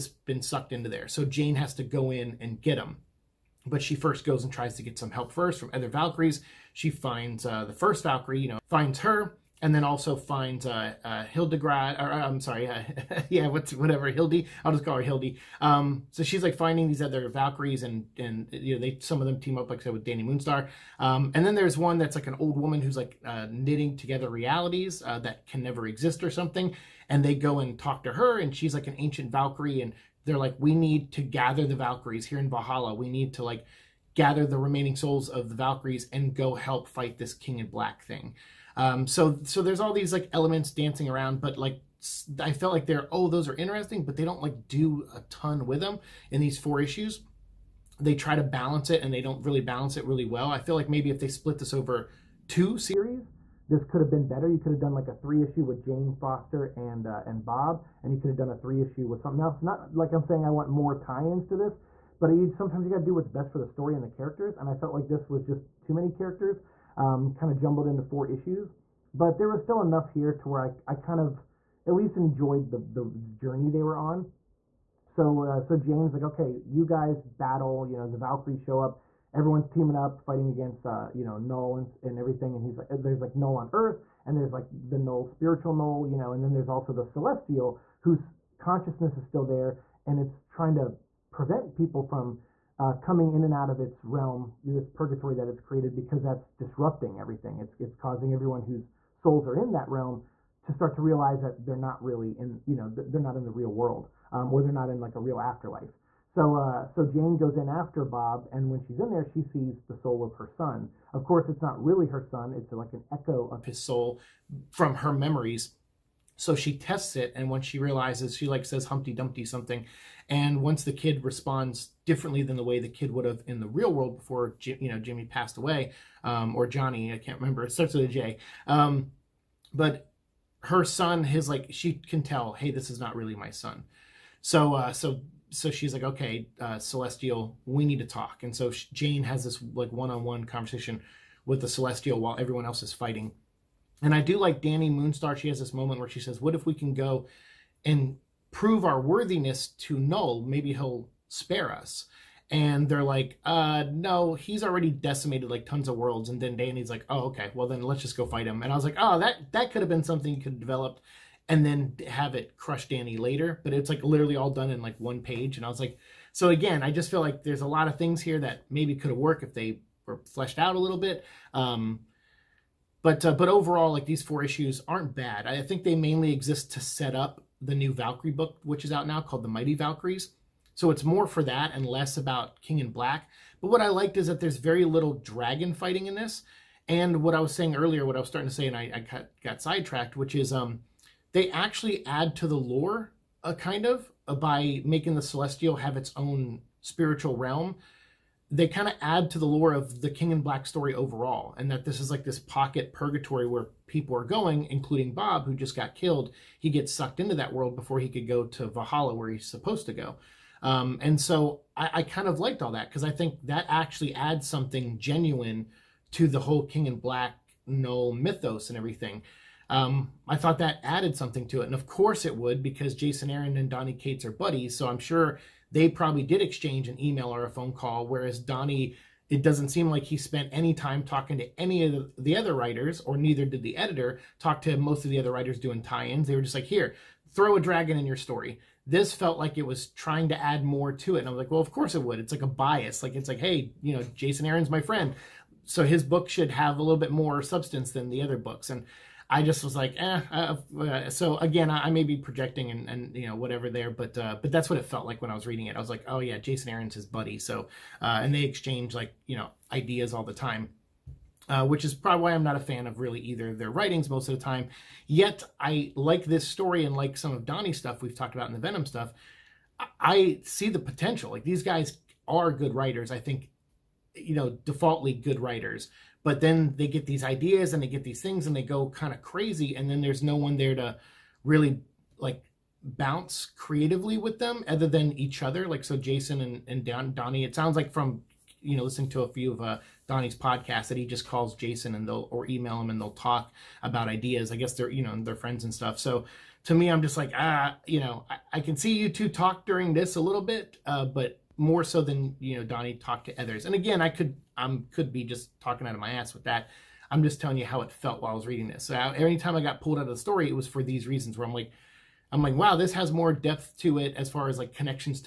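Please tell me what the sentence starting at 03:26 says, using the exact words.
He gets sucked into that world before he could go to Valhalla, where he's supposed to go.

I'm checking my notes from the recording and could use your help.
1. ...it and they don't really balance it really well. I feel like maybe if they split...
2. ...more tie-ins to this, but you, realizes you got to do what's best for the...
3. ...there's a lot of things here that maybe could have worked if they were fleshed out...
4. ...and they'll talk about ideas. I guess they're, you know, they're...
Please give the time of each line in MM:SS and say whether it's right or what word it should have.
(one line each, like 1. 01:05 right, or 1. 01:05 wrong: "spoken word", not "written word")
1. 00:48 right
2. 01:00 wrong: "sometimes", not "realizes"
3. 02:47 right
4. 04:52 right.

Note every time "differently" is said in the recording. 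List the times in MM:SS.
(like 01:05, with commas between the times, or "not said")
02:02.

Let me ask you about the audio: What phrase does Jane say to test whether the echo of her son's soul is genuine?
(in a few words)
Humpty Dumpty.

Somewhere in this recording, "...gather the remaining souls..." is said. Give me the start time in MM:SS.
00:34.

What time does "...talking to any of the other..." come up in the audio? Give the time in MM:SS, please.
03:51.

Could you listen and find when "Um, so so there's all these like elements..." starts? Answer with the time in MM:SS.
00:38.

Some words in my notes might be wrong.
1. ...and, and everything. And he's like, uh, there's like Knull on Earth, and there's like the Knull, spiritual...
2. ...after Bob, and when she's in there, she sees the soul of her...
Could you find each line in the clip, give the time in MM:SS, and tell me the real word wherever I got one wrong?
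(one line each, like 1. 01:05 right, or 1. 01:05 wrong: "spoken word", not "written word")
1. 01:21 right
2. 01:47 right.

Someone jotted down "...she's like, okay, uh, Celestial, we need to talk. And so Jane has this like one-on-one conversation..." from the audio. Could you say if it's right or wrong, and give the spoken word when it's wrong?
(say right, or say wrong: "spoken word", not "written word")
right.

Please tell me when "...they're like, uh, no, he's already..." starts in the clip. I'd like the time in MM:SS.
02:32.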